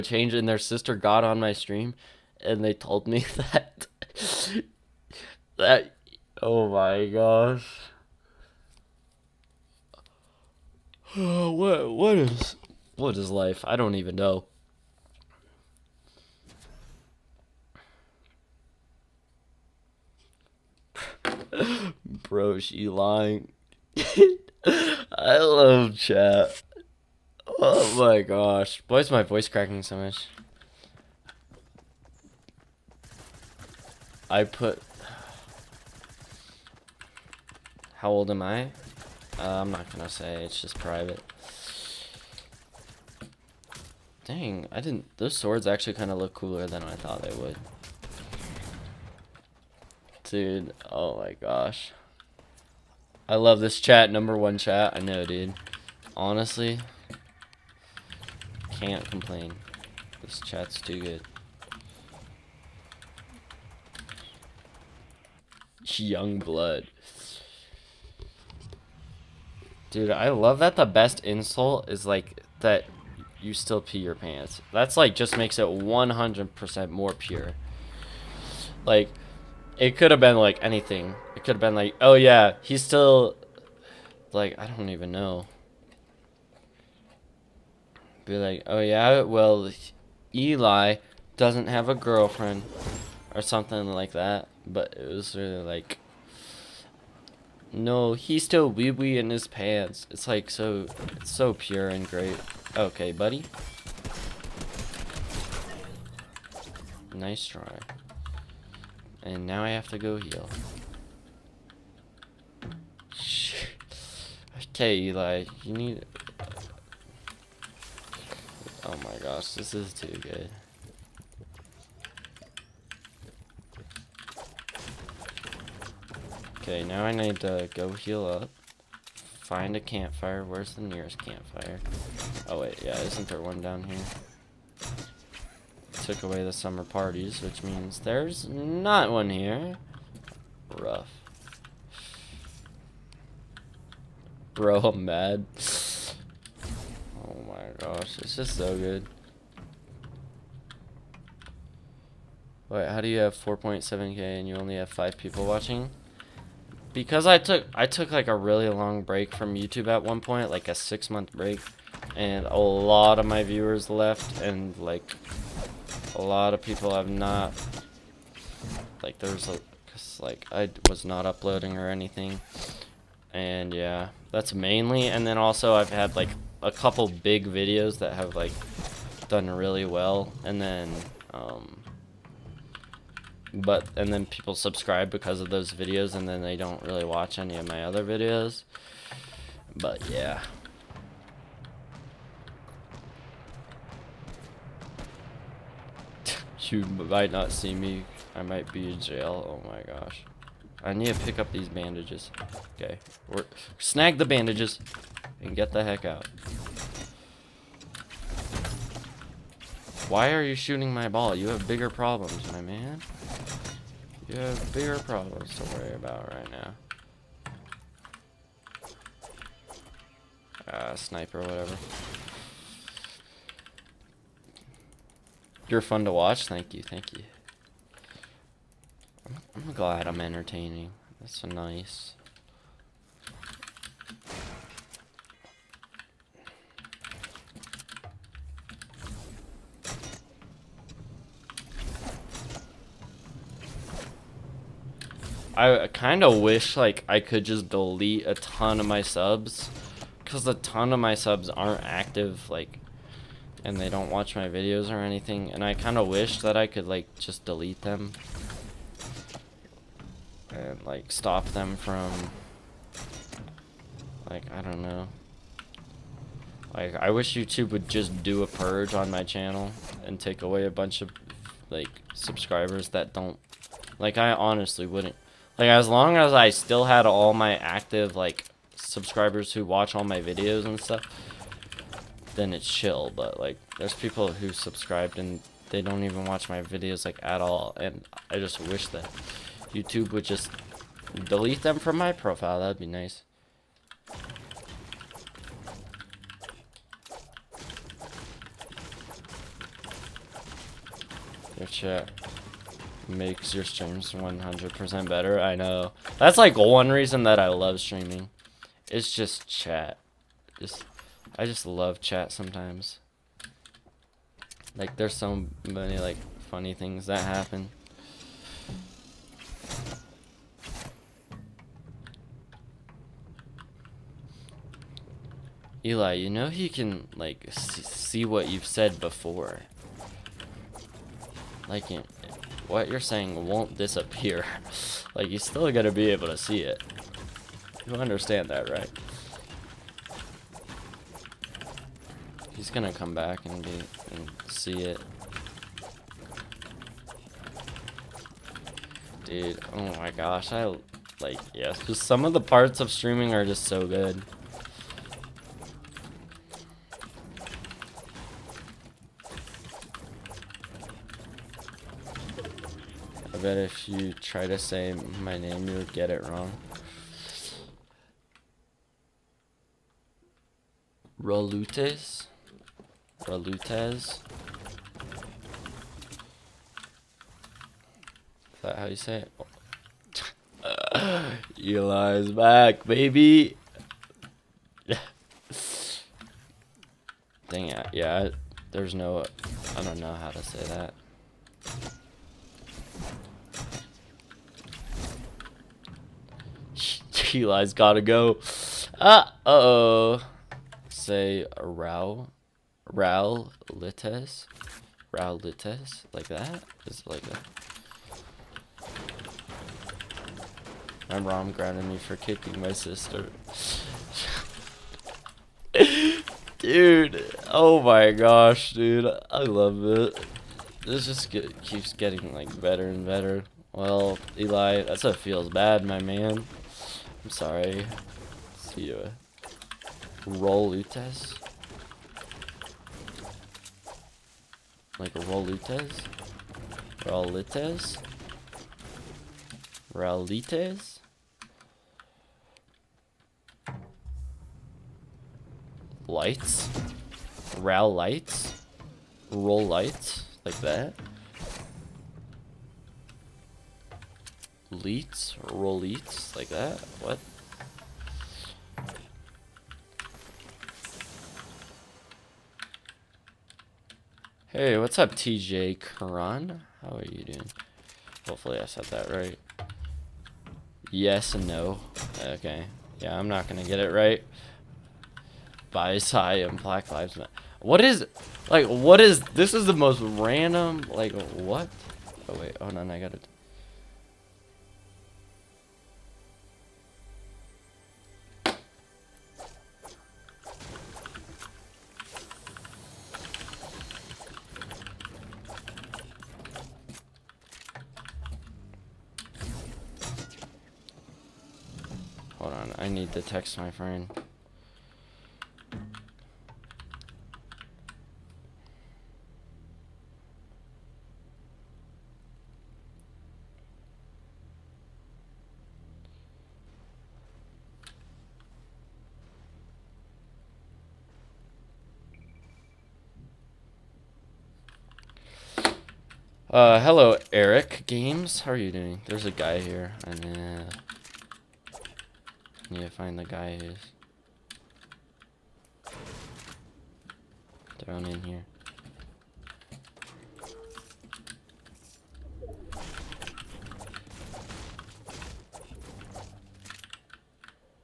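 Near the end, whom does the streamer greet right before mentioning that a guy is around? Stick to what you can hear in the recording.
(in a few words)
Eric Games.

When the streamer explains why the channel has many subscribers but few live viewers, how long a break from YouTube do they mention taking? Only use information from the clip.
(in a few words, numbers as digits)
6 months.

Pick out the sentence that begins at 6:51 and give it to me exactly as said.
My mom grounded me for kicking my sister.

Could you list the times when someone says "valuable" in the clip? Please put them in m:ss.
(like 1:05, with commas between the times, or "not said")
not said.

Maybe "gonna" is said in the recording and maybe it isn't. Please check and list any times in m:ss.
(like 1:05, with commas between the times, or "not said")
0:39, 5:35, 5:42, 7:53.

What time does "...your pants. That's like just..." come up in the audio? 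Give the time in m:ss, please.
1:13.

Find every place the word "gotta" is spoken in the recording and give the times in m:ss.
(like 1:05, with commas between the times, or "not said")
6:37, 8:02.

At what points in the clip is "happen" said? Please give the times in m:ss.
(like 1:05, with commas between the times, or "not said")
5:17.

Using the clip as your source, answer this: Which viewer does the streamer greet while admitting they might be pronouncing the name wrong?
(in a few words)
TJ Karan.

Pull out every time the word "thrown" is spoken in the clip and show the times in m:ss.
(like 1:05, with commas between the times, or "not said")
8:57.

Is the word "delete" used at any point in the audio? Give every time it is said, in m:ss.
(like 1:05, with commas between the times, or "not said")
4:07, 4:17, 4:51.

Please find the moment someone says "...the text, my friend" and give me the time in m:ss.
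8:23.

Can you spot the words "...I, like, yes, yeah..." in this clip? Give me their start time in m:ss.
5:50.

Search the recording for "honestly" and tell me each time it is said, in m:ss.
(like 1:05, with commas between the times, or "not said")
0:56, 4:34.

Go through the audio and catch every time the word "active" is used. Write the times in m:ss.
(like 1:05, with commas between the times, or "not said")
4:11, 4:37.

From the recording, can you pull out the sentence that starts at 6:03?
bet if you try to say my name, you'll get it wrong.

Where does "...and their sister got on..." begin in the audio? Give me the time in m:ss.
0:00.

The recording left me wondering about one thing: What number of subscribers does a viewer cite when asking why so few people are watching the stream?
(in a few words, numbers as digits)
4.7k.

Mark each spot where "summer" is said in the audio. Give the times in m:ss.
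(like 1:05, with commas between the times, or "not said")
2:16.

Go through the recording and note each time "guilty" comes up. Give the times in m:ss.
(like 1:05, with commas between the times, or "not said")
not said.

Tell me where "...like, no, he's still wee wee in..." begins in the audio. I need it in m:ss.
1:35.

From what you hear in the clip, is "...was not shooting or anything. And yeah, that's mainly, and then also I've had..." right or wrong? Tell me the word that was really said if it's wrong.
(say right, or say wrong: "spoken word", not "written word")
wrong: "uploading", not "shooting".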